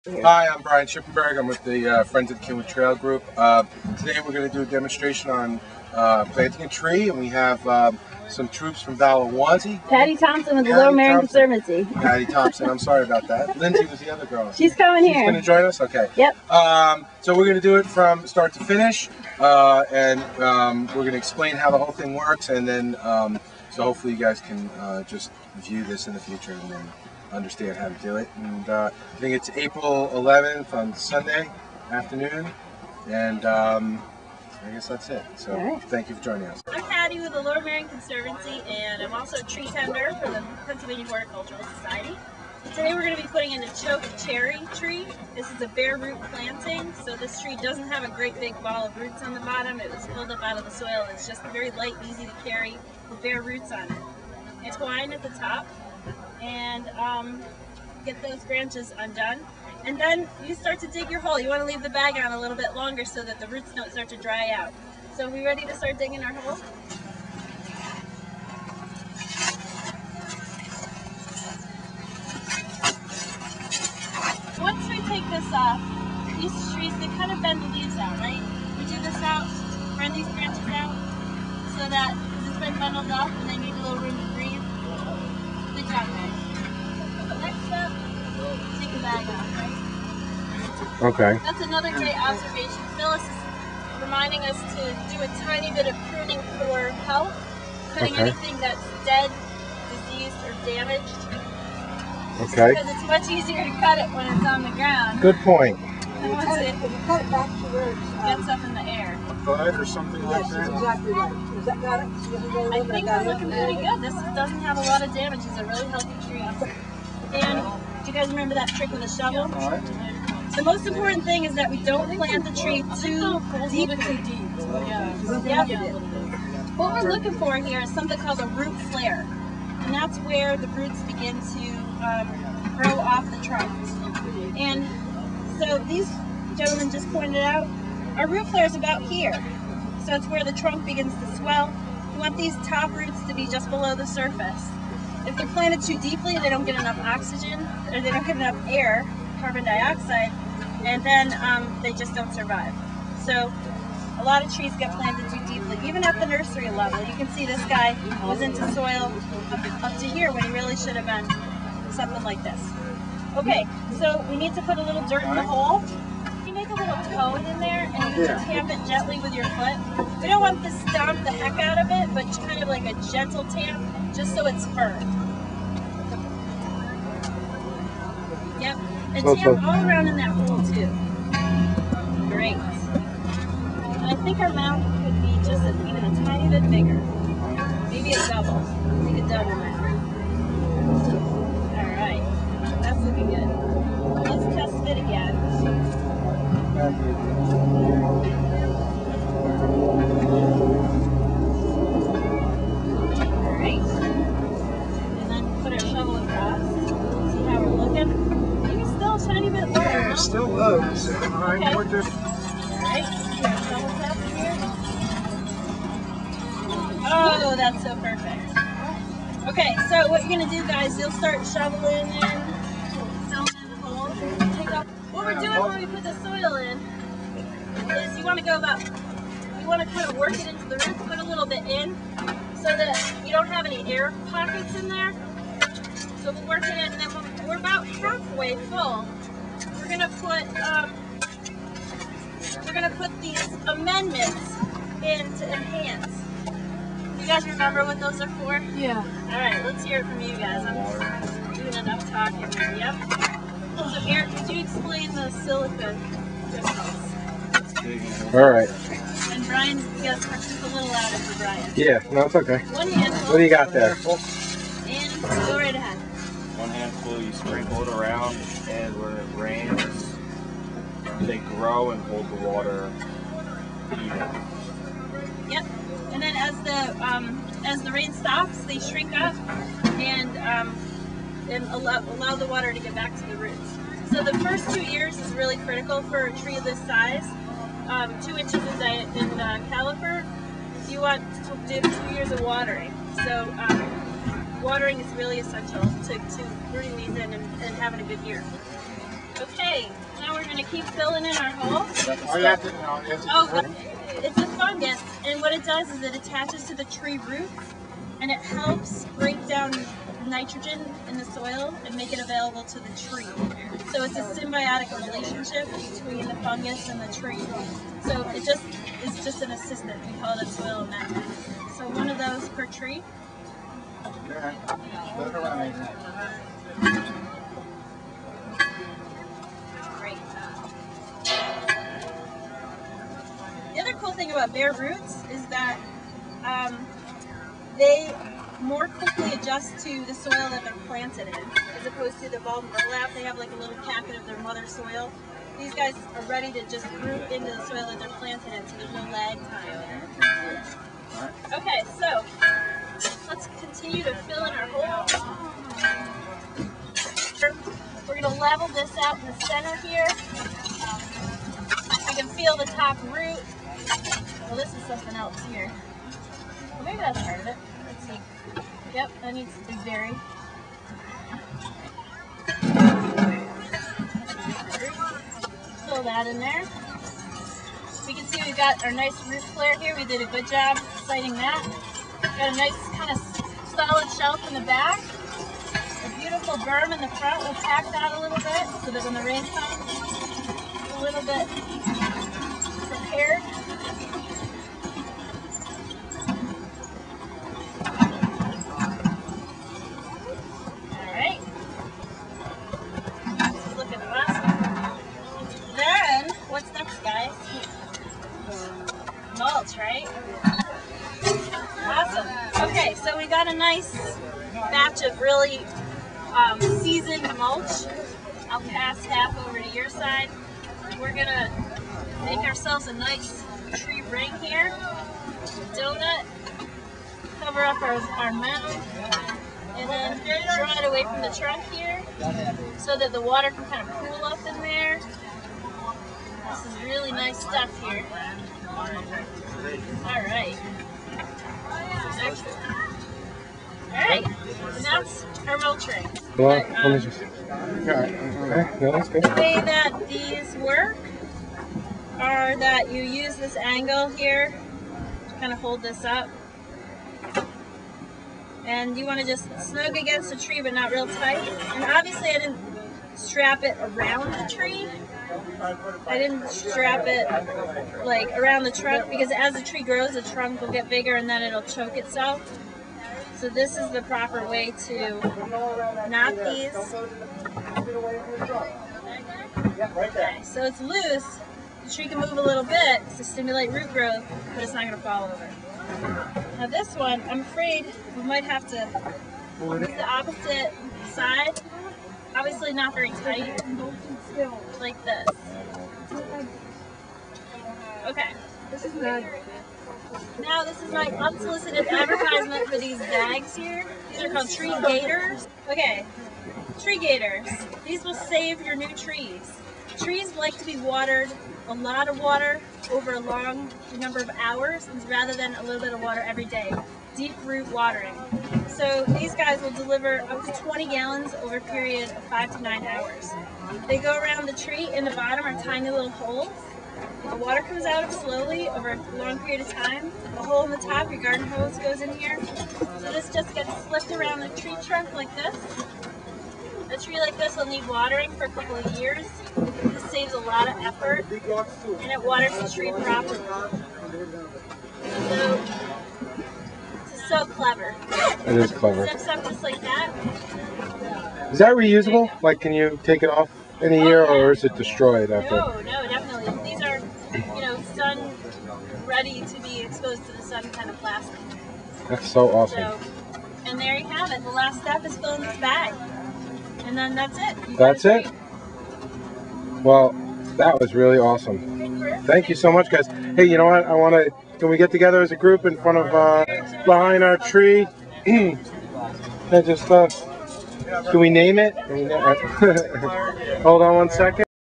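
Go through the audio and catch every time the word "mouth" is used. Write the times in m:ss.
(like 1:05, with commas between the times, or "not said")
3:04, 3:09.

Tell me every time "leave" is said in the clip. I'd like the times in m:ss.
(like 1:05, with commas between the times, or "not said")
1:01, 1:17.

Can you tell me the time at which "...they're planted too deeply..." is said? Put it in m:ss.
2:25.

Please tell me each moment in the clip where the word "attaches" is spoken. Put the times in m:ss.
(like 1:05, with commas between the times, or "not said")
5:06.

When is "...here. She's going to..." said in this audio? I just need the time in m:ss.
0:15.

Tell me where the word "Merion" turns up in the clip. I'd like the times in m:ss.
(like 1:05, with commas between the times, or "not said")
0:10, 0:37.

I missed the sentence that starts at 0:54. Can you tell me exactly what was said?
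It's twine at the top, and um, get those branches undone.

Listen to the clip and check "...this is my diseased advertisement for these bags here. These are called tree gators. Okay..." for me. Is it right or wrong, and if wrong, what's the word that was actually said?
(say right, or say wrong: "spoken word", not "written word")
wrong: "unsolicited", not "diseased".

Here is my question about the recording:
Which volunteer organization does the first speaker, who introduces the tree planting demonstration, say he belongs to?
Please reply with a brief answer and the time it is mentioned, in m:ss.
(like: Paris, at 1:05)
Friends of the Cynwyd Trail, at 0:02.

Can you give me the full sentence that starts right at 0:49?
It was pulled up out of the soil.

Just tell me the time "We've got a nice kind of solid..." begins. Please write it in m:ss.
6:21.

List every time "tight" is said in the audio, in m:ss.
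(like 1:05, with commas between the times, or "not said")
7:41, 8:13.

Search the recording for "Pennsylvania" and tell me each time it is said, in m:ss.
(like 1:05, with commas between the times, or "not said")
0:40.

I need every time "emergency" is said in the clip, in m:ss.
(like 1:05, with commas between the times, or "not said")
not said.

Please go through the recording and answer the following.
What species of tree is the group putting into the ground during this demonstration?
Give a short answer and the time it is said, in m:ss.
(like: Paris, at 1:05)
Choke cherry, at 0:43.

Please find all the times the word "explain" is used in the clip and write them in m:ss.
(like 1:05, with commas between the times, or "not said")
0:21, 4:14.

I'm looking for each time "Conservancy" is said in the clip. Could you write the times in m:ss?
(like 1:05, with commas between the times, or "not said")
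0:11, 0:37.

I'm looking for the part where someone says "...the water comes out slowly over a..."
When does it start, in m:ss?
8:47.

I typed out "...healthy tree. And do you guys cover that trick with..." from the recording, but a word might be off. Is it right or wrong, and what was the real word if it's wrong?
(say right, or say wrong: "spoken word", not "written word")
wrong: "remember", not "cover".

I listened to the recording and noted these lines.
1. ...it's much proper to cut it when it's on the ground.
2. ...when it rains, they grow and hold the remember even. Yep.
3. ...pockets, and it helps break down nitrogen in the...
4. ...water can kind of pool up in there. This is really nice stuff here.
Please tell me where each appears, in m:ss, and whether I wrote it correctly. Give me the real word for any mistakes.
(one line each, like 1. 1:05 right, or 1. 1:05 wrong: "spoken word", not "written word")
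1. 1:42 wrong: "easier", not "proper"
2. 4:28 wrong: "water", not "remember"
3. 5:07 wrong: "roots", not "pockets"
4. 7:13 right.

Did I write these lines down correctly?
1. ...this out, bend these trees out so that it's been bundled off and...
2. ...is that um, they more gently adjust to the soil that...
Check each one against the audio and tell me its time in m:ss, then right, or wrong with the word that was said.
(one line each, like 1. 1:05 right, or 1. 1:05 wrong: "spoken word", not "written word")
1. 1:19 wrong: "branches", not "trees"
2. 5:35 wrong: "quickly", not "gently".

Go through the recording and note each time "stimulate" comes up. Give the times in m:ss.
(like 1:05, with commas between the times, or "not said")
8:03.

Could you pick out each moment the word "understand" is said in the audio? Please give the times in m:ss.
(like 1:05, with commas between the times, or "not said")
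0:27.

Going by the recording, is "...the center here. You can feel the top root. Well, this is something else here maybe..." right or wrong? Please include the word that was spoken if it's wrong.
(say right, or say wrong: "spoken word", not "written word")
right.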